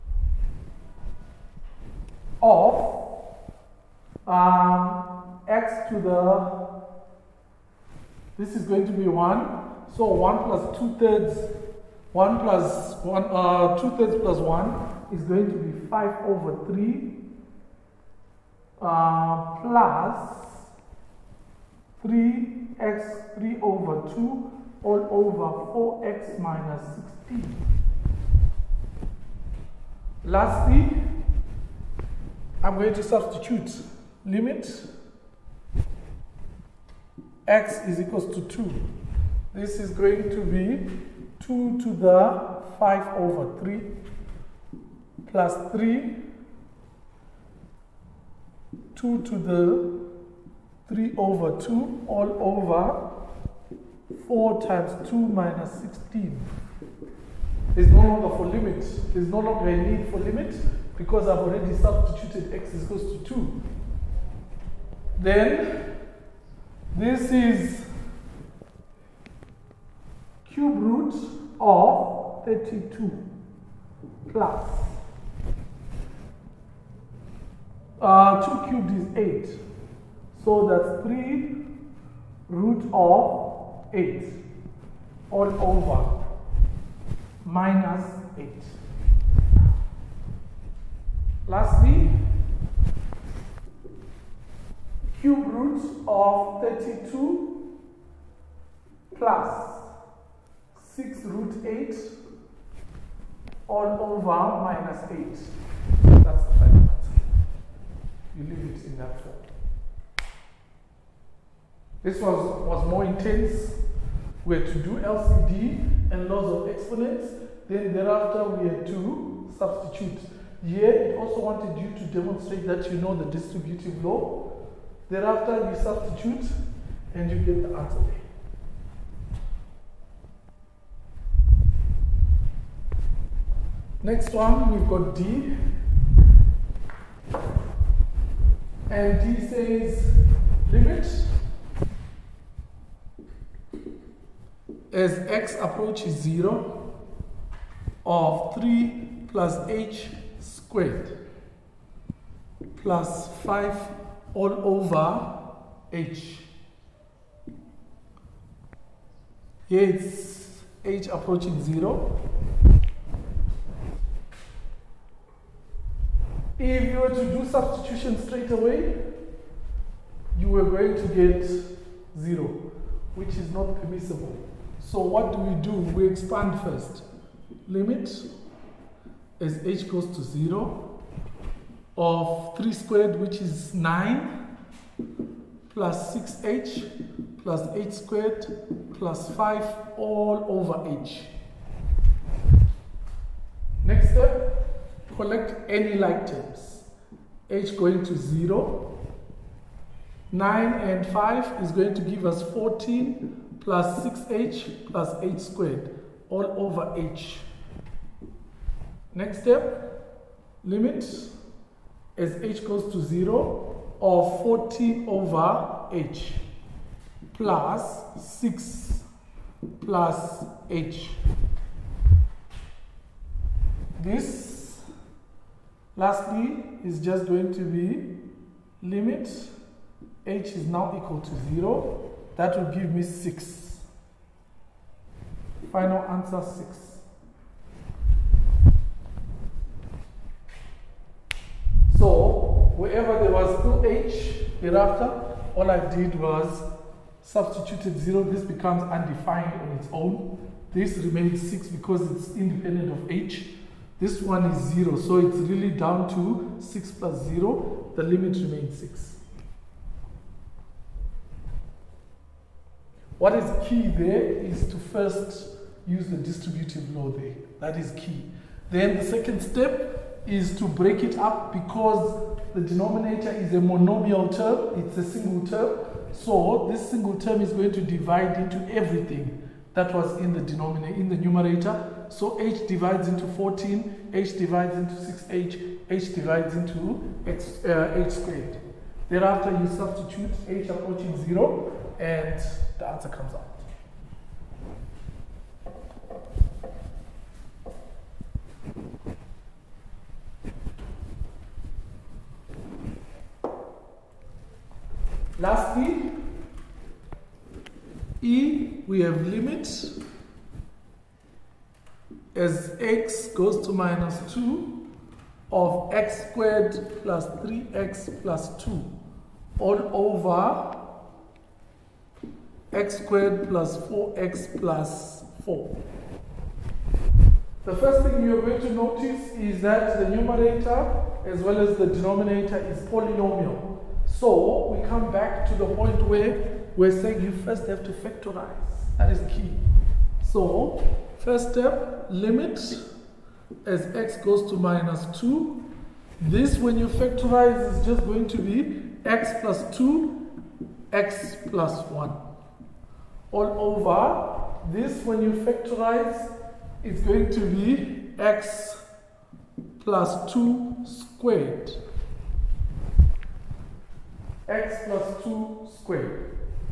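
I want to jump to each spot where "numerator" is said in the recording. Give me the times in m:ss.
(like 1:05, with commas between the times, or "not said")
4:41, 5:30.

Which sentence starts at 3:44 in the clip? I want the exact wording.
This Lastly, is just going to be limit h is now equal to 0.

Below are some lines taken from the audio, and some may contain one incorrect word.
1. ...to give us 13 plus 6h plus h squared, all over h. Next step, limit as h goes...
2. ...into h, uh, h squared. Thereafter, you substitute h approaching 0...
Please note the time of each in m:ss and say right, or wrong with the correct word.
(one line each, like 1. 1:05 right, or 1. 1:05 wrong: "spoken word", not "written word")
1. 3:21 wrong: "14", not "13"
2. 4:46 right.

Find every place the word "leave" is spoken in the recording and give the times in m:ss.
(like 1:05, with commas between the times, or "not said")
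1:48.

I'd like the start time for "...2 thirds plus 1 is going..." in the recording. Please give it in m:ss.
0:13.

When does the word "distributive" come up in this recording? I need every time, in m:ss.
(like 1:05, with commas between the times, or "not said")
2:03, 4:26.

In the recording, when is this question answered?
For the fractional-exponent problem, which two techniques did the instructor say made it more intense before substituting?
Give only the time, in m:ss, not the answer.
1:54.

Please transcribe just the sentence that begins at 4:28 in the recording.
Then the second step is to break it up because the denominator is a monomial term, it's a single term.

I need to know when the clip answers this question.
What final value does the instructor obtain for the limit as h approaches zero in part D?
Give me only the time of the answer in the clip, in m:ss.
3:55.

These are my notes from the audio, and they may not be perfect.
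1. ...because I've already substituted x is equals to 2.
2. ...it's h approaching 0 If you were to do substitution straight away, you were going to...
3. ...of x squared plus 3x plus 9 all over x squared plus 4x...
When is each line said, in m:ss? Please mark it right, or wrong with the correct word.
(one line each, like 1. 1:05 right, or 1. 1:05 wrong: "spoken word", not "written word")
1. 1:00 right
2. 2:39 right
3. 5:15 wrong: "2", not "9".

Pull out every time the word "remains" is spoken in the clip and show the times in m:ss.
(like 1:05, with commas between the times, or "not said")
4:10, 4:18.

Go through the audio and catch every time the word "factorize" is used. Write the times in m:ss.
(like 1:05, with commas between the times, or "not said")
5:37, 5:46, 5:55.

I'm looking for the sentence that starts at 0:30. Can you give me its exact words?
Lastly, I'm going to substitute limit x is equals to 2.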